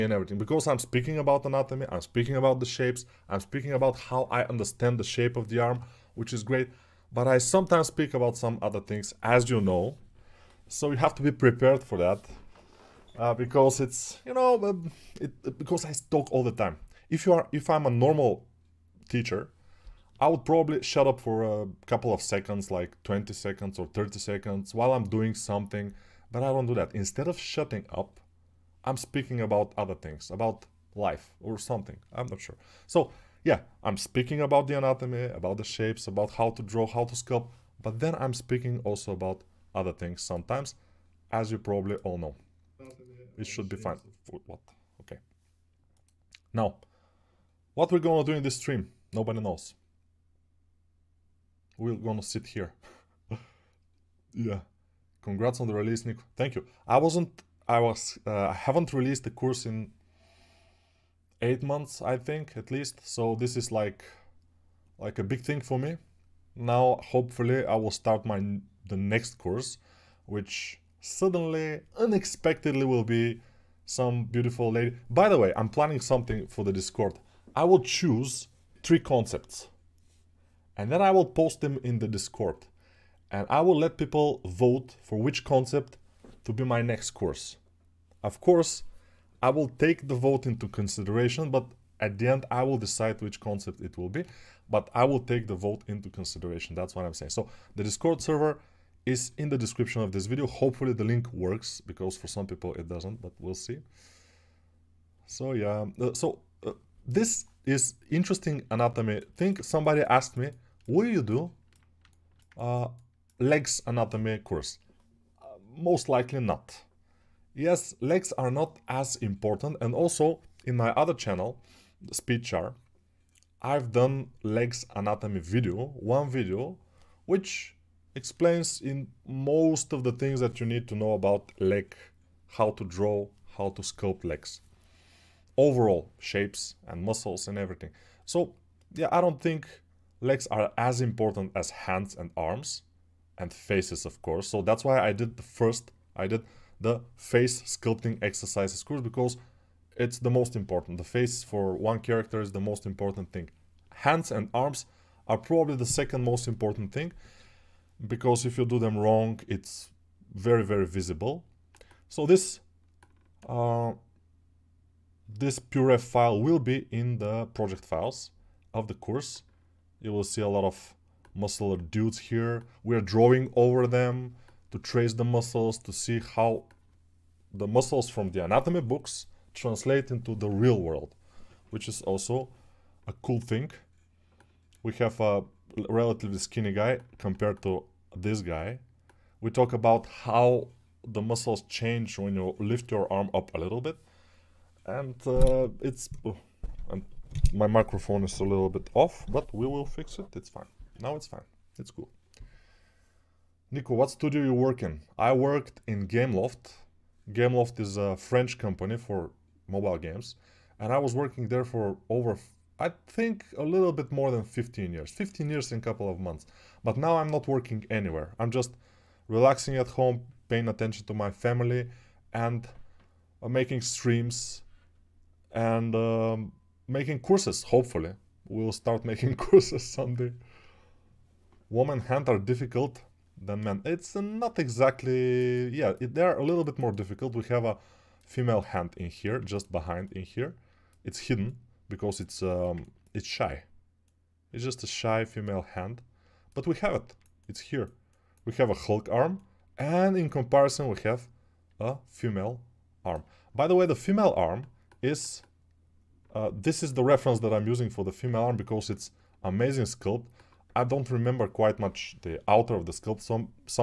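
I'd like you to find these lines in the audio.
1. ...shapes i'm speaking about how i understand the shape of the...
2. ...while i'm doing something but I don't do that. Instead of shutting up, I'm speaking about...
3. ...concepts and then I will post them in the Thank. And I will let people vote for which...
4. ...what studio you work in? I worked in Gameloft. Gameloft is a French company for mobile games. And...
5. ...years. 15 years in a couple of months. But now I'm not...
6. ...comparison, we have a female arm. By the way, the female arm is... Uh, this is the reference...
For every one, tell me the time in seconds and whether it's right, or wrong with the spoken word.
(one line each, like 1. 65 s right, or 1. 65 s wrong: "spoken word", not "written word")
1. 2 s right
2. 24 s right
3. 78 s wrong: "Discord", not "Thank"
4. 203 s right
5. 214 s right
6. 250 s right.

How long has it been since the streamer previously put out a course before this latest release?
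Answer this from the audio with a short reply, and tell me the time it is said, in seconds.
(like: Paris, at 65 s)
8 months, at 61 s.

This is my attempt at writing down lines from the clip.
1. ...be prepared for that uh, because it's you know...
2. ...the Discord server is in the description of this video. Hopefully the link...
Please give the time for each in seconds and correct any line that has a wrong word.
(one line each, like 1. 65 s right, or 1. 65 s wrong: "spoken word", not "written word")
1. 11 s right
2. 97 s right.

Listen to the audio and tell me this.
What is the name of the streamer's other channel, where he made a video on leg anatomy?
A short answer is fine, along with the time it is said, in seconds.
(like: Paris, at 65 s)
SpeedChar, at 122 s.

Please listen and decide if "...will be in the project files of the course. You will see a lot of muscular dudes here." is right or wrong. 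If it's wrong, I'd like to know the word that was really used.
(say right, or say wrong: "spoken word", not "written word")
right.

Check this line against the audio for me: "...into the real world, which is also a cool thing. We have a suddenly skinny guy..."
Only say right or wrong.
wrong.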